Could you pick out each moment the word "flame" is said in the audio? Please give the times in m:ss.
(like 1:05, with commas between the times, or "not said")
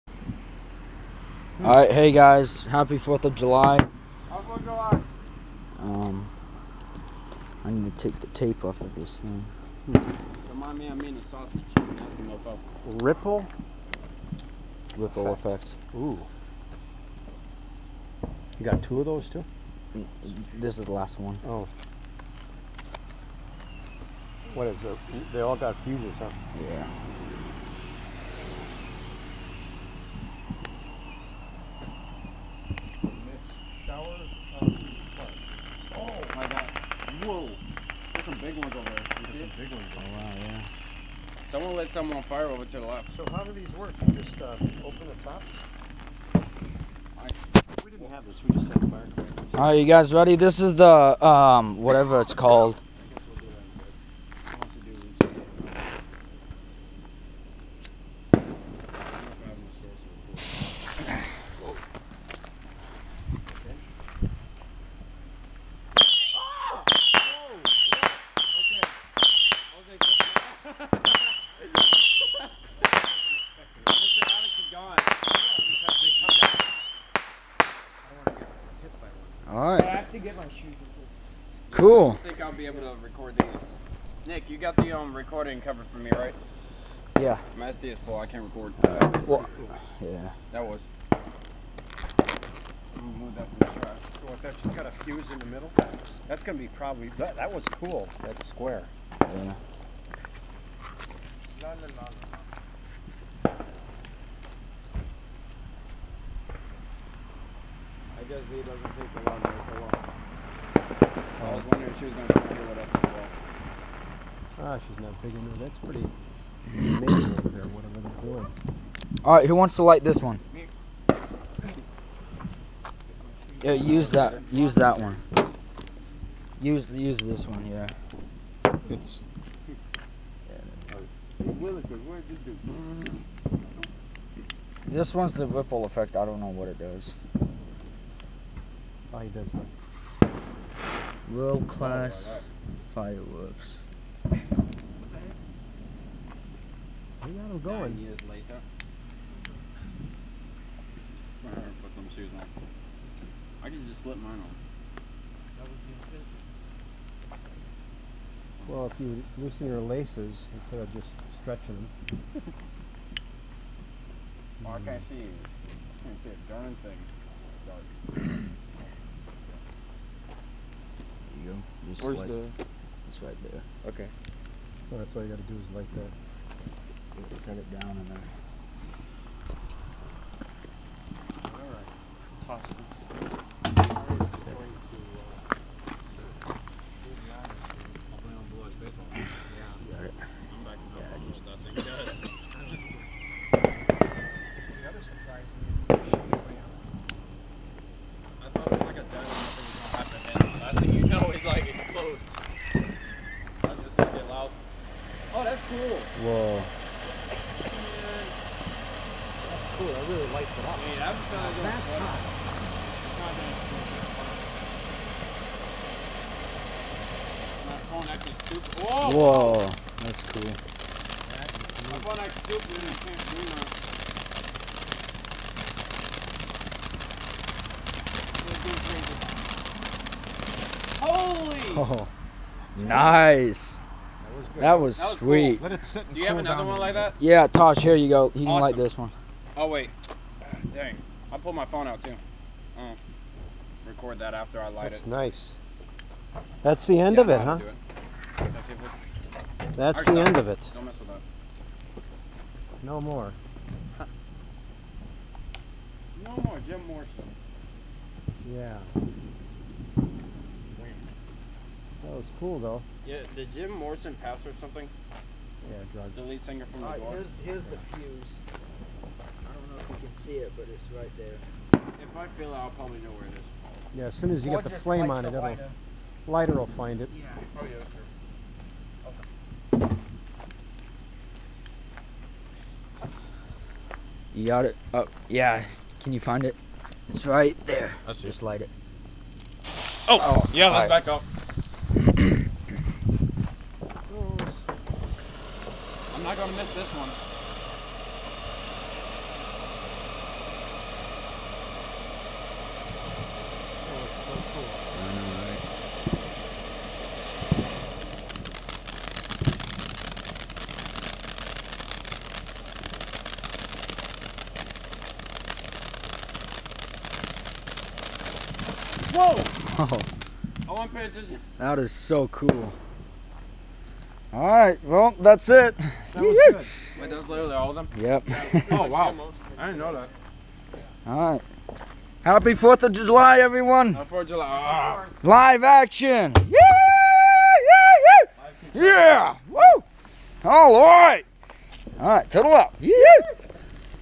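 4:34.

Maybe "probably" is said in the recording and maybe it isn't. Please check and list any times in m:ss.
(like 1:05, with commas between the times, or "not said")
1:36, 4:32.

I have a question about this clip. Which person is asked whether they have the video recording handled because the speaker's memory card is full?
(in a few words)
Nick.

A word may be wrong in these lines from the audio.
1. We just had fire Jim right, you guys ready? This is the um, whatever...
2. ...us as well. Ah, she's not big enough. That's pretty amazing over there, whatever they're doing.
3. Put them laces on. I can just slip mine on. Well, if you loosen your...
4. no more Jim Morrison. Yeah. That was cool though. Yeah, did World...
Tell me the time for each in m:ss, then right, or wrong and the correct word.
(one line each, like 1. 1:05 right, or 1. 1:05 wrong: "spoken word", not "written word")
1. 0:48 wrong: "All", not "Jim"
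2. 1:52 right
3. 2:31 wrong: "shoes", not "laces"
4. 4:16 wrong: "Jim", not "World".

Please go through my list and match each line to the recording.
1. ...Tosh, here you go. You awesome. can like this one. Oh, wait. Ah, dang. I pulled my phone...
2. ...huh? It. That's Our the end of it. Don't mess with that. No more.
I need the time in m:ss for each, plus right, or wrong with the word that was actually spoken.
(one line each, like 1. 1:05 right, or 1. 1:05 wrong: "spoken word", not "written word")
1. 3:57 right
2. 4:07 right.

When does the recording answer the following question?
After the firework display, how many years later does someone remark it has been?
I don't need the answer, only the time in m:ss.
2:27.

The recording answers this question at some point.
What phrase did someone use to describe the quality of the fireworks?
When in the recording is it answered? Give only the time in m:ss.
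2:21.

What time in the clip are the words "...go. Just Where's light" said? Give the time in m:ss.
2:51.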